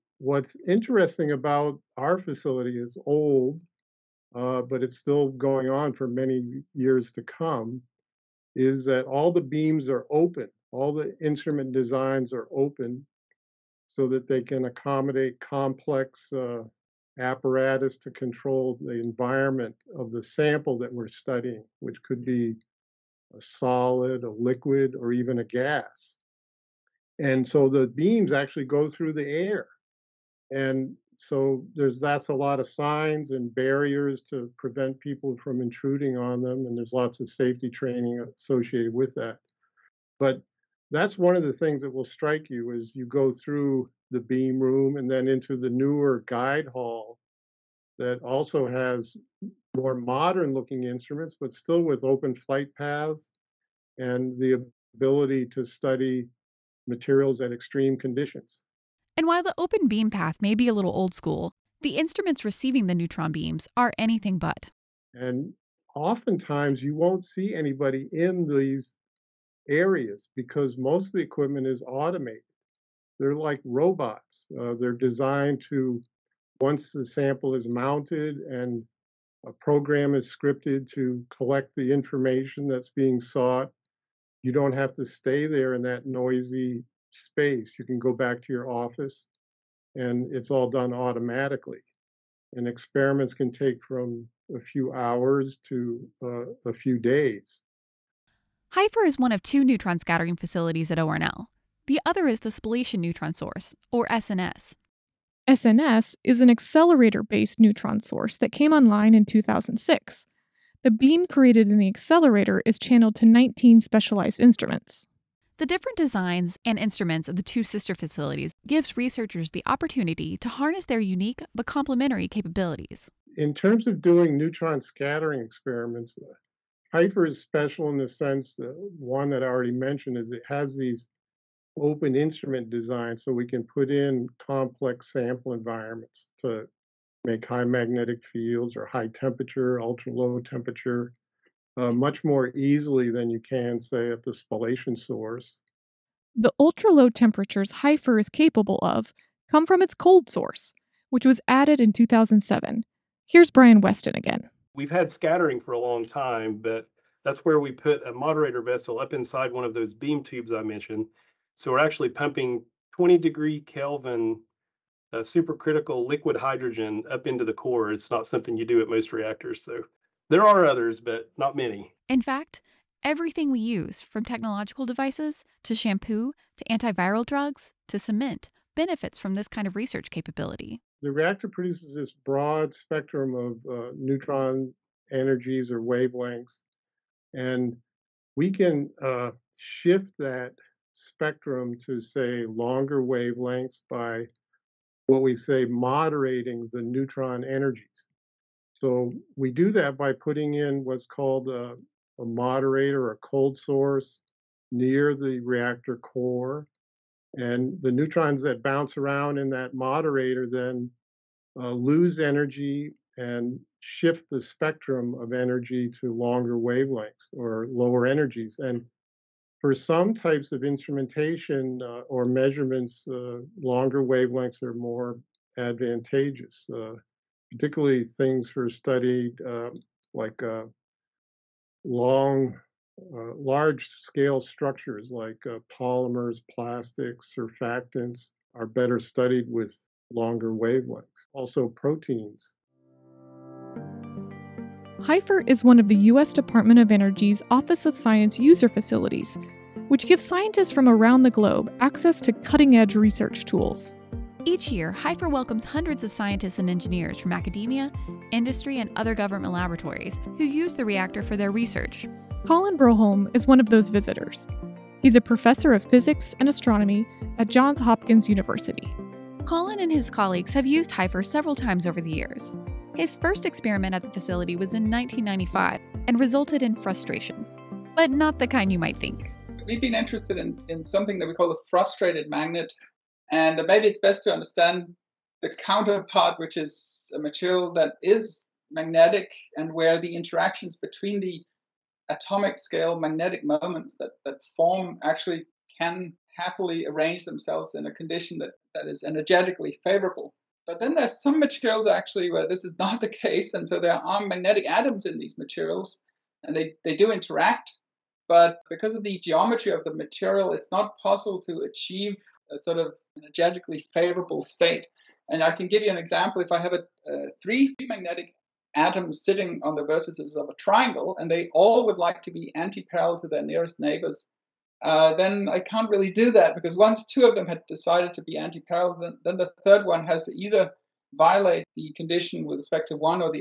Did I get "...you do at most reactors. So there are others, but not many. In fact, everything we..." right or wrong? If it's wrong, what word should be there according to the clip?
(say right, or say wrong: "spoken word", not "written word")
right.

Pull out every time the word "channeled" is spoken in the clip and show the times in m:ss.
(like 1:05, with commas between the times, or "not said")
1:52.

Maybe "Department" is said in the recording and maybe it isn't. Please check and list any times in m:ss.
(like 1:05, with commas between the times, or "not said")
4:06.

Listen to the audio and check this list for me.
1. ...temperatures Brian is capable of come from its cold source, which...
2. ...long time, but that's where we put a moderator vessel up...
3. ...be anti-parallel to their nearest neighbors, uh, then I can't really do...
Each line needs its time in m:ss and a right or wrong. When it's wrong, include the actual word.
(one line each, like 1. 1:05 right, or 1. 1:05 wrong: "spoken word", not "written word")
1. 2:27 wrong: "HFIR", not "Brian"
2. 2:35 right
3. 5:22 right.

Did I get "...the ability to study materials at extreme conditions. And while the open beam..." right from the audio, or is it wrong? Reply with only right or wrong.
right.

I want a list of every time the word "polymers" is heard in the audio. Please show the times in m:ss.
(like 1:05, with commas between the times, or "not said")
3:55.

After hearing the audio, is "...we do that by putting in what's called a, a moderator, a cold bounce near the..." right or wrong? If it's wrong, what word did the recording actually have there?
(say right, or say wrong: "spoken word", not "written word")
wrong: "source", not "bounce".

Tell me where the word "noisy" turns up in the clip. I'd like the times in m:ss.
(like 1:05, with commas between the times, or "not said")
1:26.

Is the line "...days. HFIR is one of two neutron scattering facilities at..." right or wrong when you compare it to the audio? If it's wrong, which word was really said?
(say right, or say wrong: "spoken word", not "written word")
right.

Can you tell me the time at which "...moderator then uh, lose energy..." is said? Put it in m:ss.
3:29.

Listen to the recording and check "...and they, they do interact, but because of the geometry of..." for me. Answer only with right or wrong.
right.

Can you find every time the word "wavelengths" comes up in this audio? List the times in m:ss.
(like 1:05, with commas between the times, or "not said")
3:05, 3:13, 3:36, 3:44, 4:00.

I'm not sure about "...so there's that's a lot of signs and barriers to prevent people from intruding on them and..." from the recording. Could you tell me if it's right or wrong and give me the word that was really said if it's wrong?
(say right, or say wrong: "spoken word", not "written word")
right.